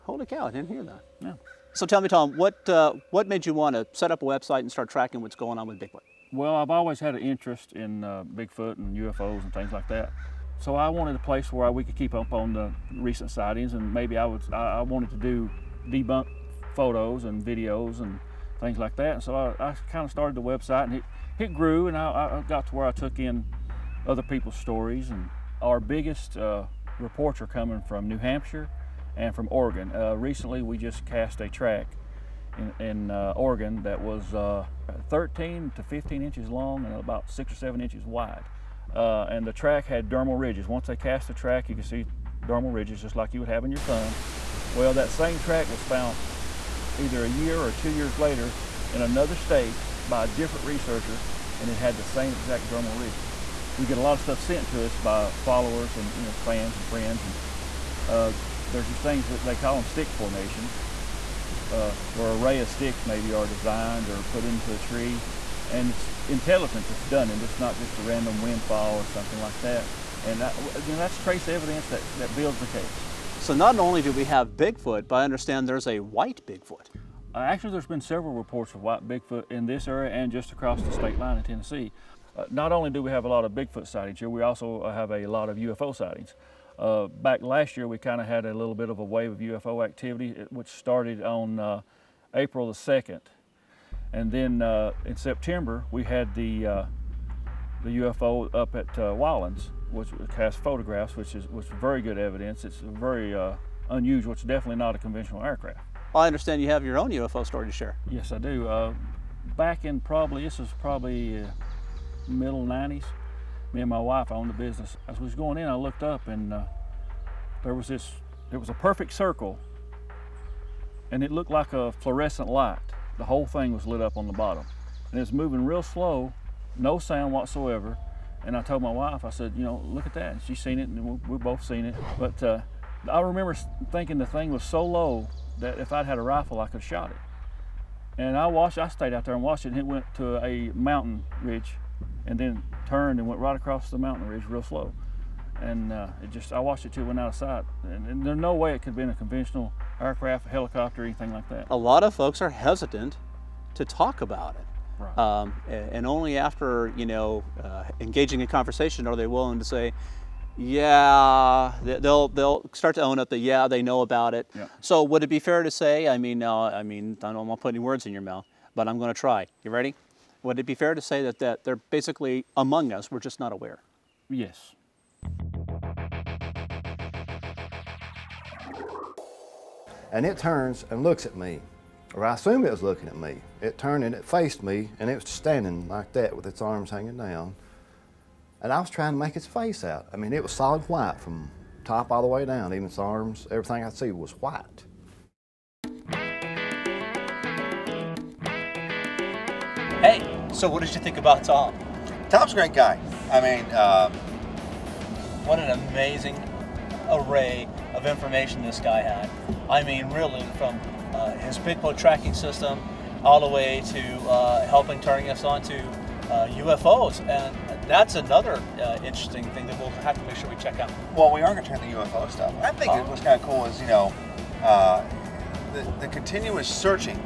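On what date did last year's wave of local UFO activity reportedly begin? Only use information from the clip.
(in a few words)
April 2.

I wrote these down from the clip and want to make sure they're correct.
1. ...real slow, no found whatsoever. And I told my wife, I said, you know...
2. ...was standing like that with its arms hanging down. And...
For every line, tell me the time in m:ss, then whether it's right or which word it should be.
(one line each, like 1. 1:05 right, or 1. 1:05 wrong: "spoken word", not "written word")
1. 2:05 wrong: "sound", not "found"
2. 3:05 right.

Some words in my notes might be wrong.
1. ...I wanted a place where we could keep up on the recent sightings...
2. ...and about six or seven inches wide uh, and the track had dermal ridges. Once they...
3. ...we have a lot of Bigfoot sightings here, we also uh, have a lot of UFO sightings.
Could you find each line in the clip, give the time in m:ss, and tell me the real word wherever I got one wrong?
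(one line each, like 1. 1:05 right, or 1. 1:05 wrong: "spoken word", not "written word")
1. 0:10 right
2. 0:36 right
3. 1:23 right.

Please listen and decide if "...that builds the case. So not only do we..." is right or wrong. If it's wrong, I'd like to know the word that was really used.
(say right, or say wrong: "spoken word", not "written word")
right.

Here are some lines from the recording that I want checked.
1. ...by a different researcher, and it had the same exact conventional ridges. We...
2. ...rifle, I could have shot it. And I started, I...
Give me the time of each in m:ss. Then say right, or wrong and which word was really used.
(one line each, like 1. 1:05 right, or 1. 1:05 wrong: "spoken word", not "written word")
1. 0:50 wrong: "dermal", not "conventional"
2. 2:16 wrong: "watched", not "started".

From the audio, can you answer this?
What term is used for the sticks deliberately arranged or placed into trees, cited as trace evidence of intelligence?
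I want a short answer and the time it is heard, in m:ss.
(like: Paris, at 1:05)
stick formations, at 0:59.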